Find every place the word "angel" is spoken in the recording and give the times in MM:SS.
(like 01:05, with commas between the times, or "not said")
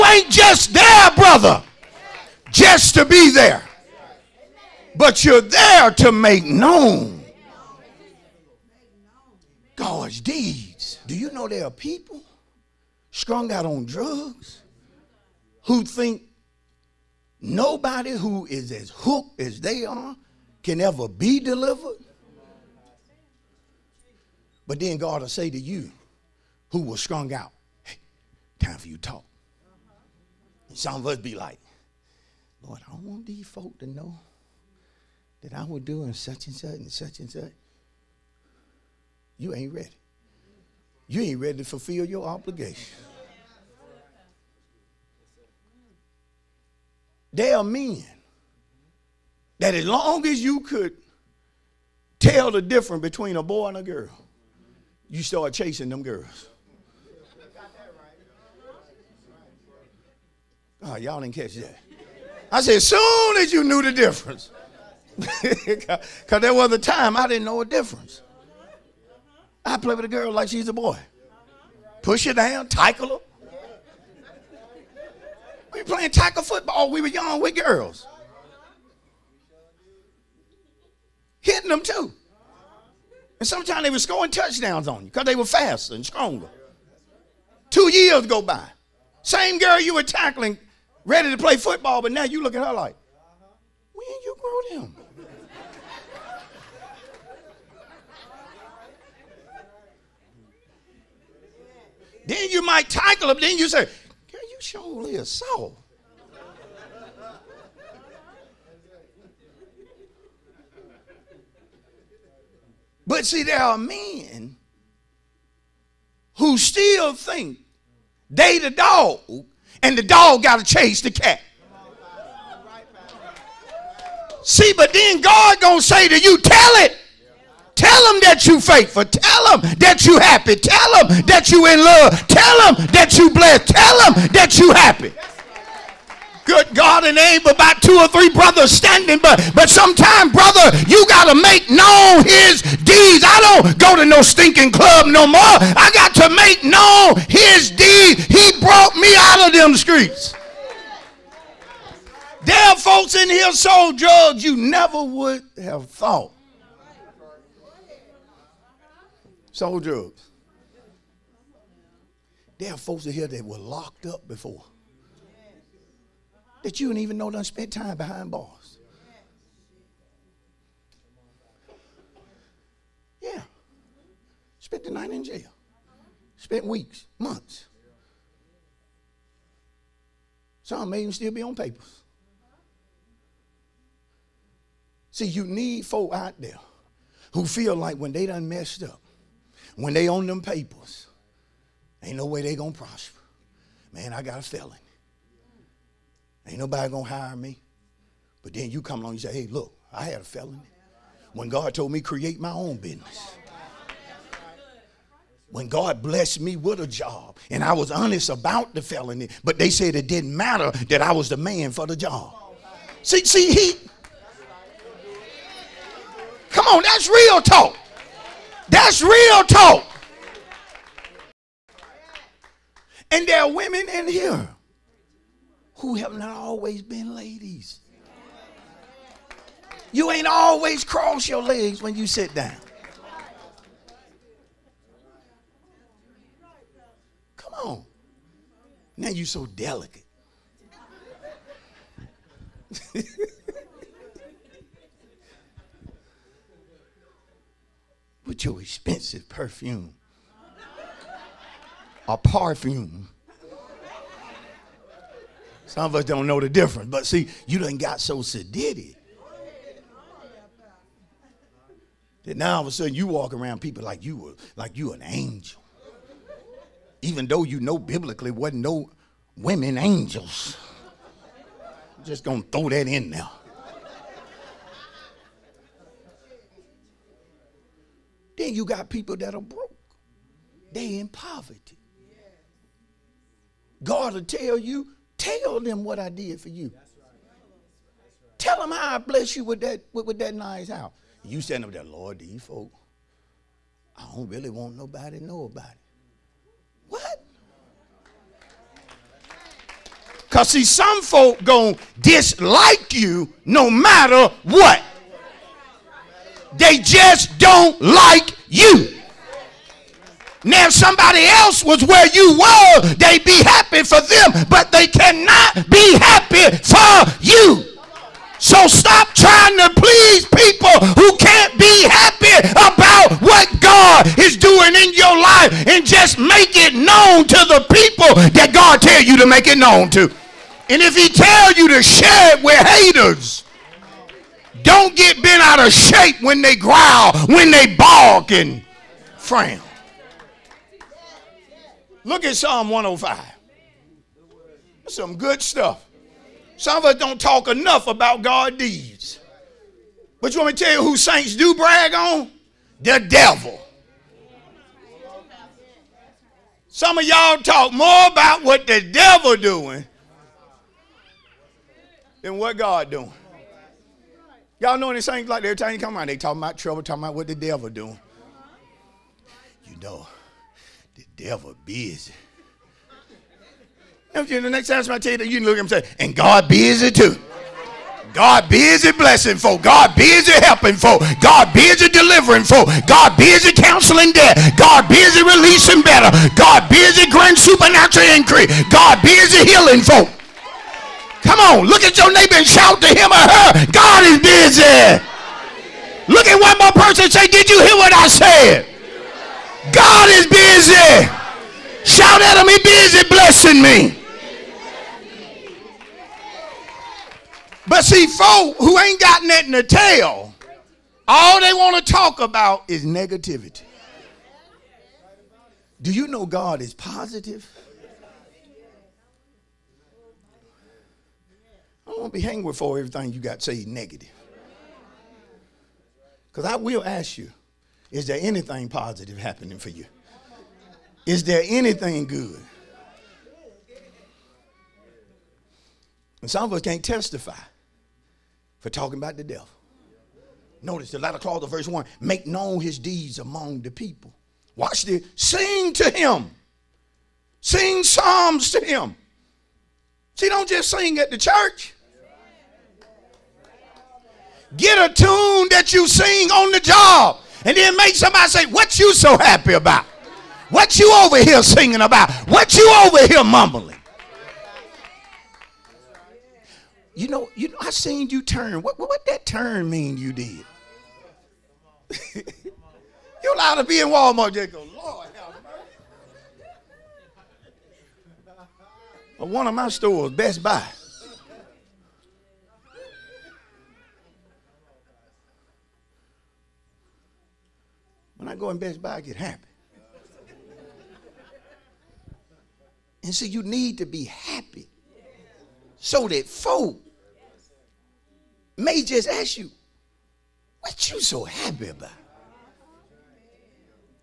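04:25, 04:29.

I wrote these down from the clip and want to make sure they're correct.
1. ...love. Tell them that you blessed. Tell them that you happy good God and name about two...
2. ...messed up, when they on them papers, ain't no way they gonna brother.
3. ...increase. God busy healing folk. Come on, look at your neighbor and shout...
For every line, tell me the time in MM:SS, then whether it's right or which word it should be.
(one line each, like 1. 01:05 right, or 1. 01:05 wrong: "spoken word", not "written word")
1. 02:11 right
2. 03:08 wrong: "prosper", not "brother"
3. 06:28 right.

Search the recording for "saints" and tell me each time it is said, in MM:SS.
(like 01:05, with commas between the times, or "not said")
05:50, 06:05.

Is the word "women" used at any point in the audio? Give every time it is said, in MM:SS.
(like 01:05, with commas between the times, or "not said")
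03:43, 04:29.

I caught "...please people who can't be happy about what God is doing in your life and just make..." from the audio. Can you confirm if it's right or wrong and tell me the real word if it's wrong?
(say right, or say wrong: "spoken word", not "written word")
right.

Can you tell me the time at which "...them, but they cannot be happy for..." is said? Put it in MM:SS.
05:13.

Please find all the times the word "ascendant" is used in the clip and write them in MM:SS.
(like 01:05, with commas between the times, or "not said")
not said.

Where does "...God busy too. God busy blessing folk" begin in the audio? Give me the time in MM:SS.
06:16.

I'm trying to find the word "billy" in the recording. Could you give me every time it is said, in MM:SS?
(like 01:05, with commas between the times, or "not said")
not said.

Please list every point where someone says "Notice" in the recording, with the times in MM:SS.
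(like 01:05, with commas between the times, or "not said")
07:20.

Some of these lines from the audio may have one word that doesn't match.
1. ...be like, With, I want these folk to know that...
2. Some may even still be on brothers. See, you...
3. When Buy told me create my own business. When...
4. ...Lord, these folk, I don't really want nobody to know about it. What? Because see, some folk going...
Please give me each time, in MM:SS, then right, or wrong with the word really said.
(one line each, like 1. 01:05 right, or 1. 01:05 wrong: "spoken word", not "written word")
1. 00:31 wrong: "Lord", not "With"
2. 03:00 wrong: "papers", not "brothers"
3. 03:21 wrong: "God", not "Buy"
4. 04:51 right.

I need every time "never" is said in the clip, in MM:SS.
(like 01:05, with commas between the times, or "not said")
02:34.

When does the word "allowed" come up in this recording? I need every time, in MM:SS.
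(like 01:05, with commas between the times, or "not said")
07:53.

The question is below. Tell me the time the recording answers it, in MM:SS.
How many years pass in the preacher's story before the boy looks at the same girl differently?
01:27.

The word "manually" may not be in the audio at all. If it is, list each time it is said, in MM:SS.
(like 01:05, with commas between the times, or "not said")
not said.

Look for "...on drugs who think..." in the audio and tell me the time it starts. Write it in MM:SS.
00:13.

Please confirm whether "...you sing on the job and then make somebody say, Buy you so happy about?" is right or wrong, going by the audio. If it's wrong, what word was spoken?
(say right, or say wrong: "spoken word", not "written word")
wrong: "What", not "Buy".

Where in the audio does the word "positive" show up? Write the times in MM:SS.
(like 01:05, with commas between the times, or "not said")
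06:56, 07:08.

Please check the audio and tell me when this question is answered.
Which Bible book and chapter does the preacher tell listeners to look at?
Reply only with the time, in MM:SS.
05:42.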